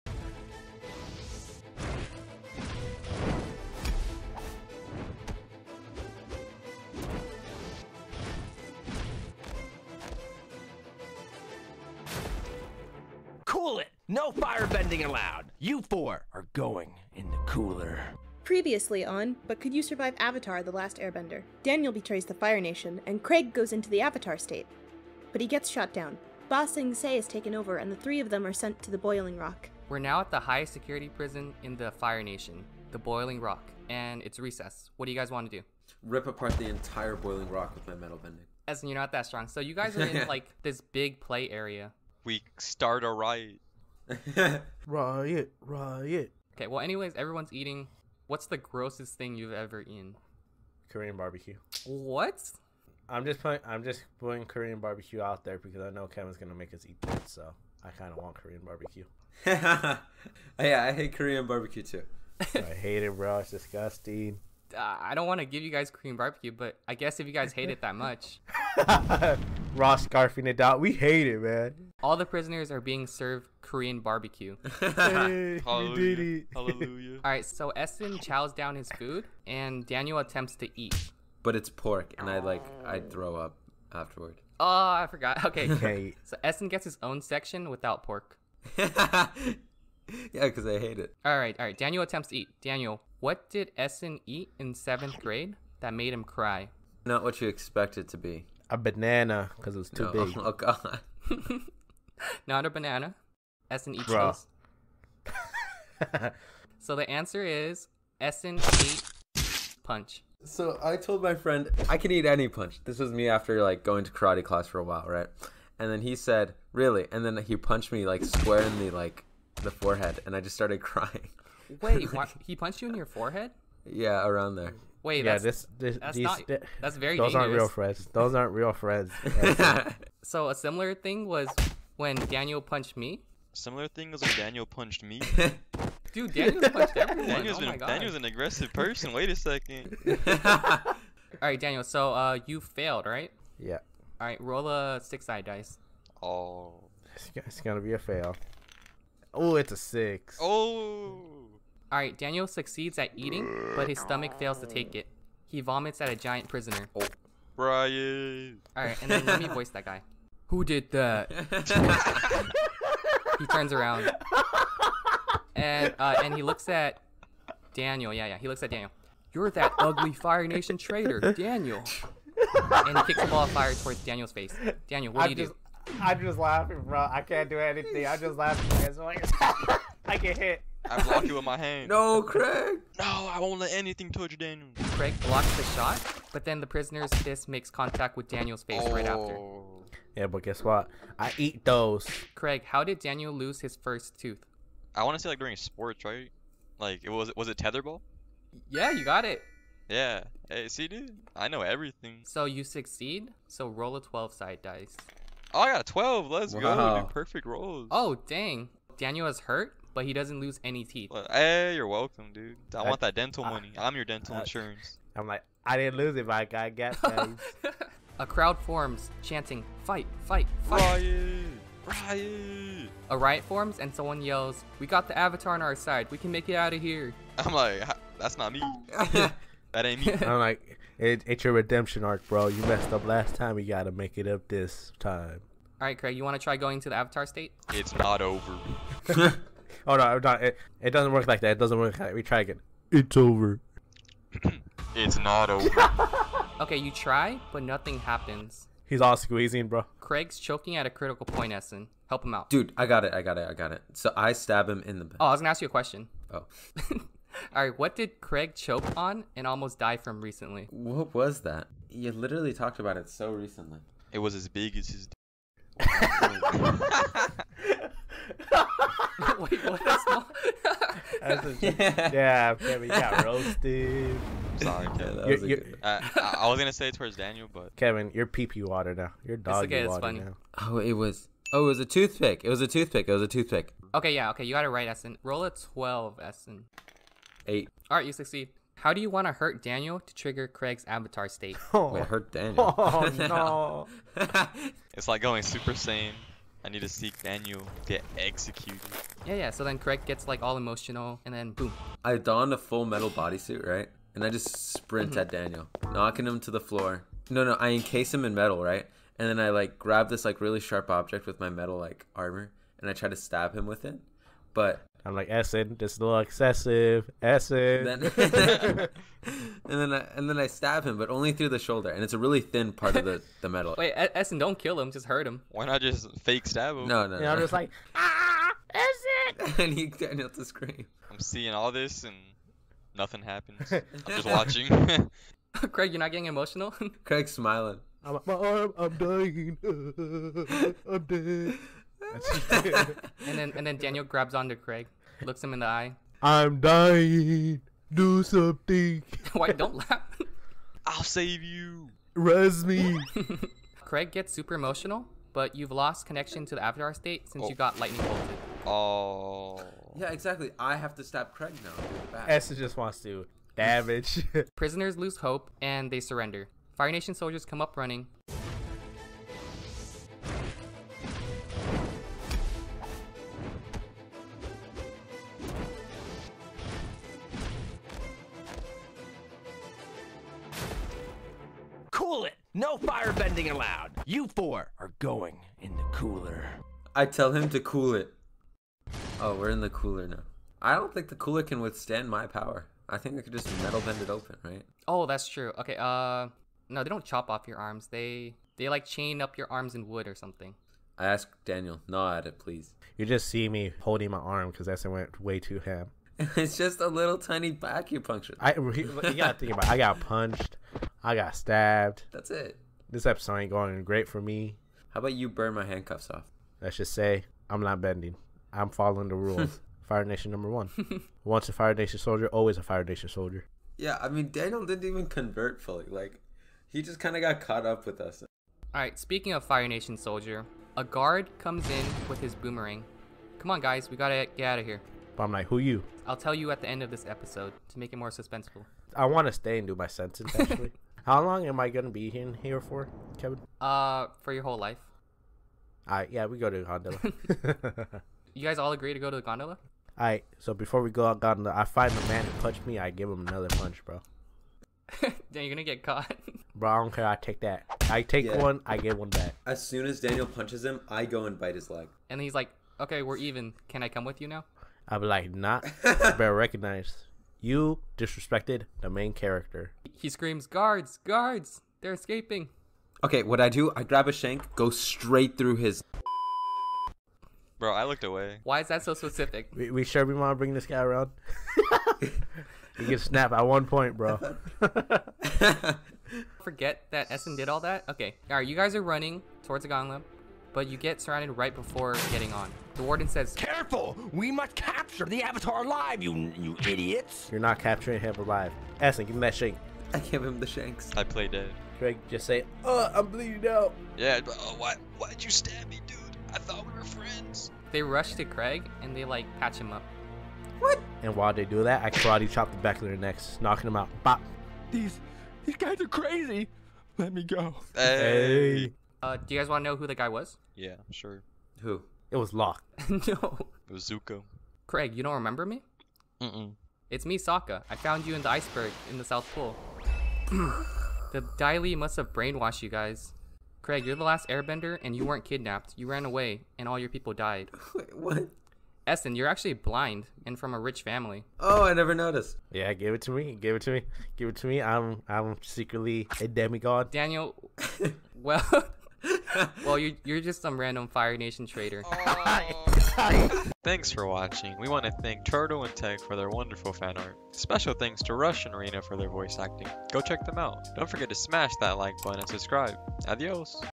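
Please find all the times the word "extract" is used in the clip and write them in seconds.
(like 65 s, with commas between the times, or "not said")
not said.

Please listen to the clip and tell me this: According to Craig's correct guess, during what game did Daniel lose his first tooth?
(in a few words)
tetherball.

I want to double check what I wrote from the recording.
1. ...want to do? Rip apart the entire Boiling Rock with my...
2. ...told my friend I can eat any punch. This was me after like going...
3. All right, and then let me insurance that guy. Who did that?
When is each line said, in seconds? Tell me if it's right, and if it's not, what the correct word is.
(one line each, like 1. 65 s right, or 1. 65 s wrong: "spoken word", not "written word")
1. 35 s right
2. 110 s right
3. 158 s wrong: "voice", not "insurance".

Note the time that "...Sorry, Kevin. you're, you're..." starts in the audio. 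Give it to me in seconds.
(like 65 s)
274 s.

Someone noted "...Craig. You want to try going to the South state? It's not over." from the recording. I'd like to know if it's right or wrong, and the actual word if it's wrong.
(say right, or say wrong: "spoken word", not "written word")
wrong: "Avatar", not "South".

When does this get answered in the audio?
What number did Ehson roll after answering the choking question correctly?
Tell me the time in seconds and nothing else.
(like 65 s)
287 s.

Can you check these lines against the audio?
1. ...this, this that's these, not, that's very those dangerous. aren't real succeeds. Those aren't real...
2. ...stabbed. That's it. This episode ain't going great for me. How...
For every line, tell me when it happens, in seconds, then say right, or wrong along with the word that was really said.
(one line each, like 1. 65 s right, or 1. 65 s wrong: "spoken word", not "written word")
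1. 125 s wrong: "friends", not "succeeds"
2. 411 s right.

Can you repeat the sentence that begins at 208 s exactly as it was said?
Daniel is hurt, but he doesn't lose any teeth.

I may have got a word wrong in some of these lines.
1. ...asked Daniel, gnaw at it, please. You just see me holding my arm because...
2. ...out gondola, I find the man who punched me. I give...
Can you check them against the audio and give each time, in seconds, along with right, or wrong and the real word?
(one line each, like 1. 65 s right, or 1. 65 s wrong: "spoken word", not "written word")
1. 401 s right
2. 451 s right.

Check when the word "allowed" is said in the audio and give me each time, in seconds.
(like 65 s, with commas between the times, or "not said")
15 s, 383 s.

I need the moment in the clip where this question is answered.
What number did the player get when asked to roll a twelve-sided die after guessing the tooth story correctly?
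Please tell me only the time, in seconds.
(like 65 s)
205 s.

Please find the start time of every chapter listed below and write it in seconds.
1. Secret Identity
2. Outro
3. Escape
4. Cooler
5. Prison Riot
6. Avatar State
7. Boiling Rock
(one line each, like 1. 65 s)
1. 519 s
2. 553 s
3. 430 s
4. 386 s
5. 157 s
6. 289 s
7. 28 s.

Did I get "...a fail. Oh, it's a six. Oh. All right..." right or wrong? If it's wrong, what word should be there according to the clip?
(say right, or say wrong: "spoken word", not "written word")
right.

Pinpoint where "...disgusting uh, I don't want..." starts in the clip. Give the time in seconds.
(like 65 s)
63 s.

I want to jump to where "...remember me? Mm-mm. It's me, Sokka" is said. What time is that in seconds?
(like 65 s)
525 s.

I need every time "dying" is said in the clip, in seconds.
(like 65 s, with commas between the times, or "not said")
338 s, 346 s.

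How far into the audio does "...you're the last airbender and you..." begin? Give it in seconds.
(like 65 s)
533 s.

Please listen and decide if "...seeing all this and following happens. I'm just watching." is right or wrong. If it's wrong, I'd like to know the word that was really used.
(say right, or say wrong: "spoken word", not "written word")
wrong: "nothing", not "following".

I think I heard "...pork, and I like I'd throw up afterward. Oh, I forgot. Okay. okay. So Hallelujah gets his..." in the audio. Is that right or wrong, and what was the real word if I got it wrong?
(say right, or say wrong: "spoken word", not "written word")
wrong: "Ehson", not "Hallelujah".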